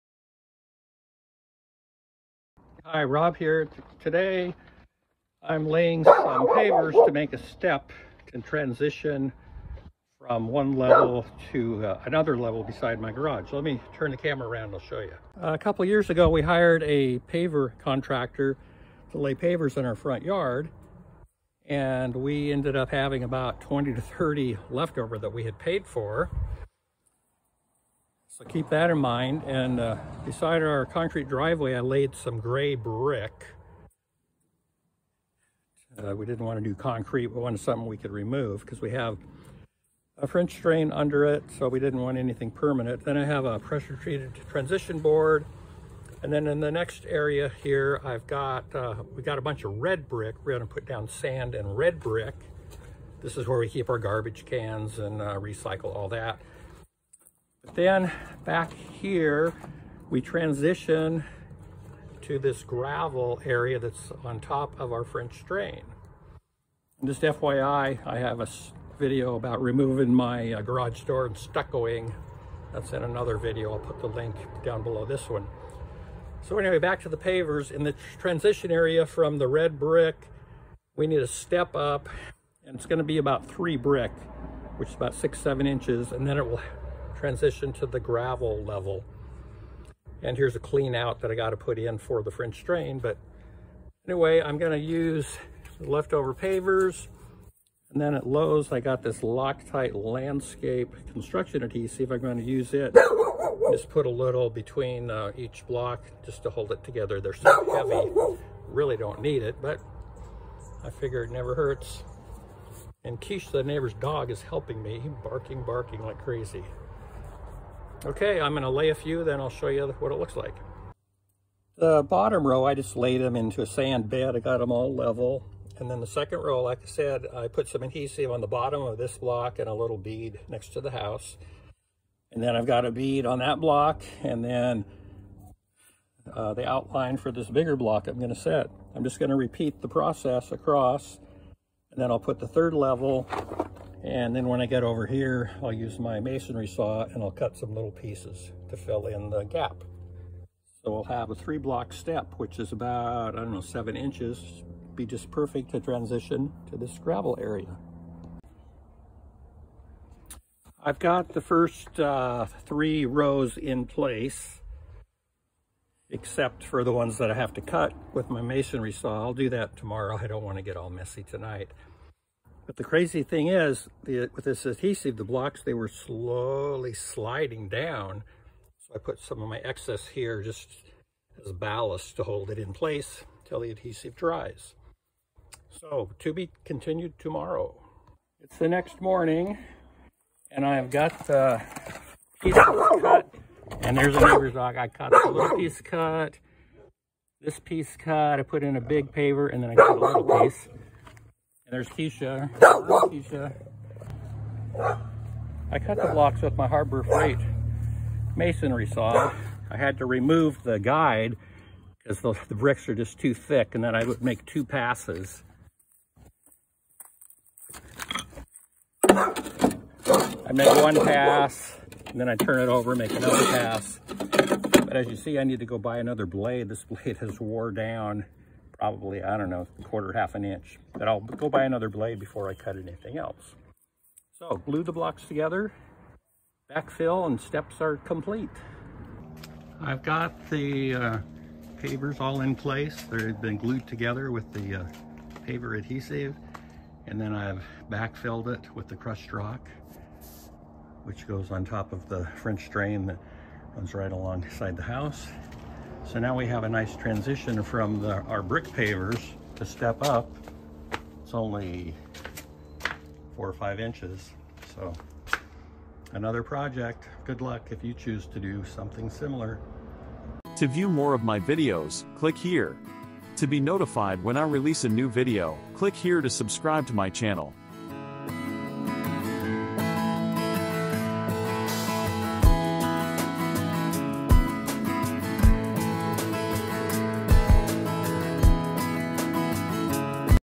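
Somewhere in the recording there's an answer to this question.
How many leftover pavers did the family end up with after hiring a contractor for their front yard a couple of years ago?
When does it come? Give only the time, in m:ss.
0:23.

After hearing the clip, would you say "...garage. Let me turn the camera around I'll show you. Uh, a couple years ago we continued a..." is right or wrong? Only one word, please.
wrong.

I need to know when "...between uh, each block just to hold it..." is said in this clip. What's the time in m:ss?
1:44.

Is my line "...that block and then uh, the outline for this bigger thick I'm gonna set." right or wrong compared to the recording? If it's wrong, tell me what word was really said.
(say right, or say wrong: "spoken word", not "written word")
wrong: "block", not "thick".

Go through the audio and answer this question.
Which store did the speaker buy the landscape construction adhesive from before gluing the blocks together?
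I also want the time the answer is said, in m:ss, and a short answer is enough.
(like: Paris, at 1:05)
Lowe's, at 1:38.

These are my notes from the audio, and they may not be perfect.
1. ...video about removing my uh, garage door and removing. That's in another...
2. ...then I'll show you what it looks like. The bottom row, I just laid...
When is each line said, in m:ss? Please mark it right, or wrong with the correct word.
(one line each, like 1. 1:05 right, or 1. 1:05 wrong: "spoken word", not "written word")
1. 1:08 wrong: "stuccoing", not "removing"
2. 1:59 right.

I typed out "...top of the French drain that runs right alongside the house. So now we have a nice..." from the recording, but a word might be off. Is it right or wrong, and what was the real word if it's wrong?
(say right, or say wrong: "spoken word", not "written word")
right.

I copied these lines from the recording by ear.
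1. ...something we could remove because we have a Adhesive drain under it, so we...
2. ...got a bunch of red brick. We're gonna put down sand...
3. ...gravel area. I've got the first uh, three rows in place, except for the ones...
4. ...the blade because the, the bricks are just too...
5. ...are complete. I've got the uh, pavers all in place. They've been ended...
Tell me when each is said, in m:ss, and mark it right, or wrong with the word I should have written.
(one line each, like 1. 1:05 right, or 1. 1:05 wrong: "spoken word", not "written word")
1. 0:37 wrong: "French", not "Adhesive"
2. 0:49 right
3. 2:36 right
4. 3:30 wrong: "guide", not "blade"
5. 3:57 wrong: "glued", not "ended".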